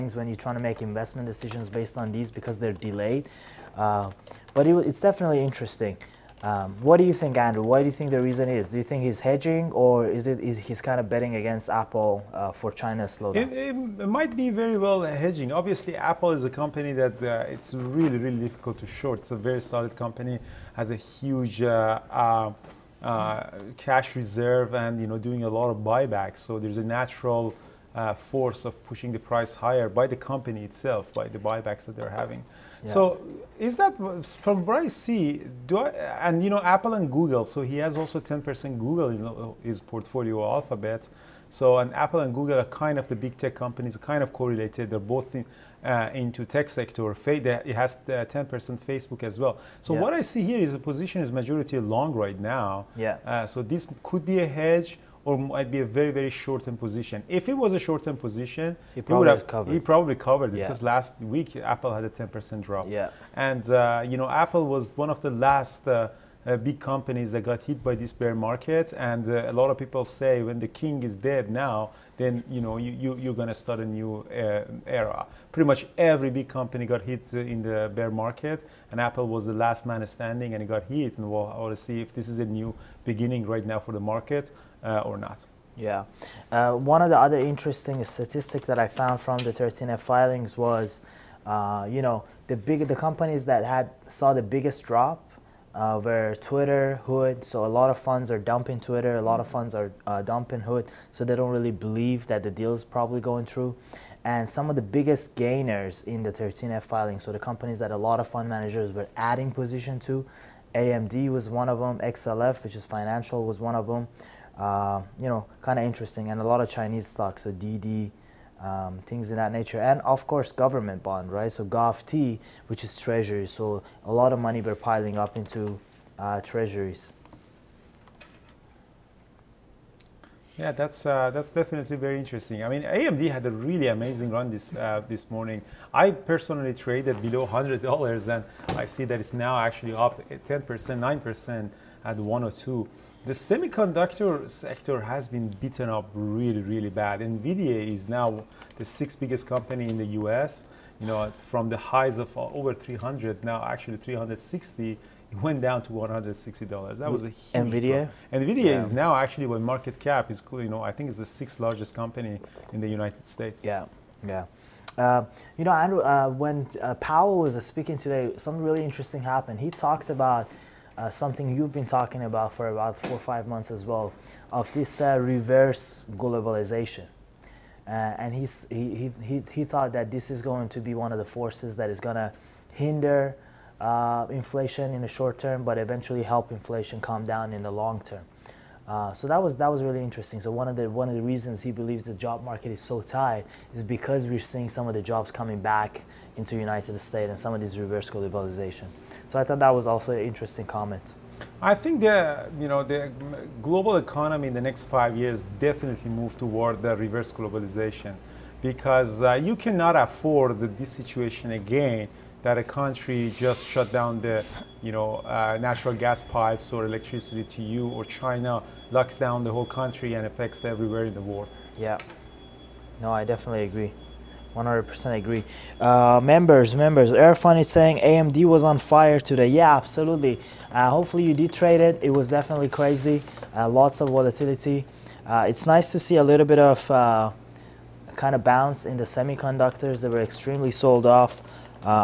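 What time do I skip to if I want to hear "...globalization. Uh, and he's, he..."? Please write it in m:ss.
2:56.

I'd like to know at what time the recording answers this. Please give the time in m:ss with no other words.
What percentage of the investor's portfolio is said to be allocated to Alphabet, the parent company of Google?
0:38.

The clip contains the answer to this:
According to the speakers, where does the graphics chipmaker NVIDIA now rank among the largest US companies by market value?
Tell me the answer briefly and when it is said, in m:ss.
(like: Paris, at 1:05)
Sixth largest, at 2:28.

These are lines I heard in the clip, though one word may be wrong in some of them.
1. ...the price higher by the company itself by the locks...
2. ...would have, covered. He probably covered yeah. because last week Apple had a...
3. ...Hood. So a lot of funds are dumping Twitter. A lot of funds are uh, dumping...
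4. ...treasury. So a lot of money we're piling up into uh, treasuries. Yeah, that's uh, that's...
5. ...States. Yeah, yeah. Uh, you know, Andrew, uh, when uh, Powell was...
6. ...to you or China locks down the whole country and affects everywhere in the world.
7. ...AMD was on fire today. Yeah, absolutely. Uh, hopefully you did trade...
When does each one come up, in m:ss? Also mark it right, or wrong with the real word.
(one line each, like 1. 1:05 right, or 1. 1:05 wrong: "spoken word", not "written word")
1. 0:29 wrong: "buybacks", not "locks"
2. 0:59 right
3. 1:37 right
4. 2:02 right
5. 2:43 right
6. 3:37 right
7. 3:47 right.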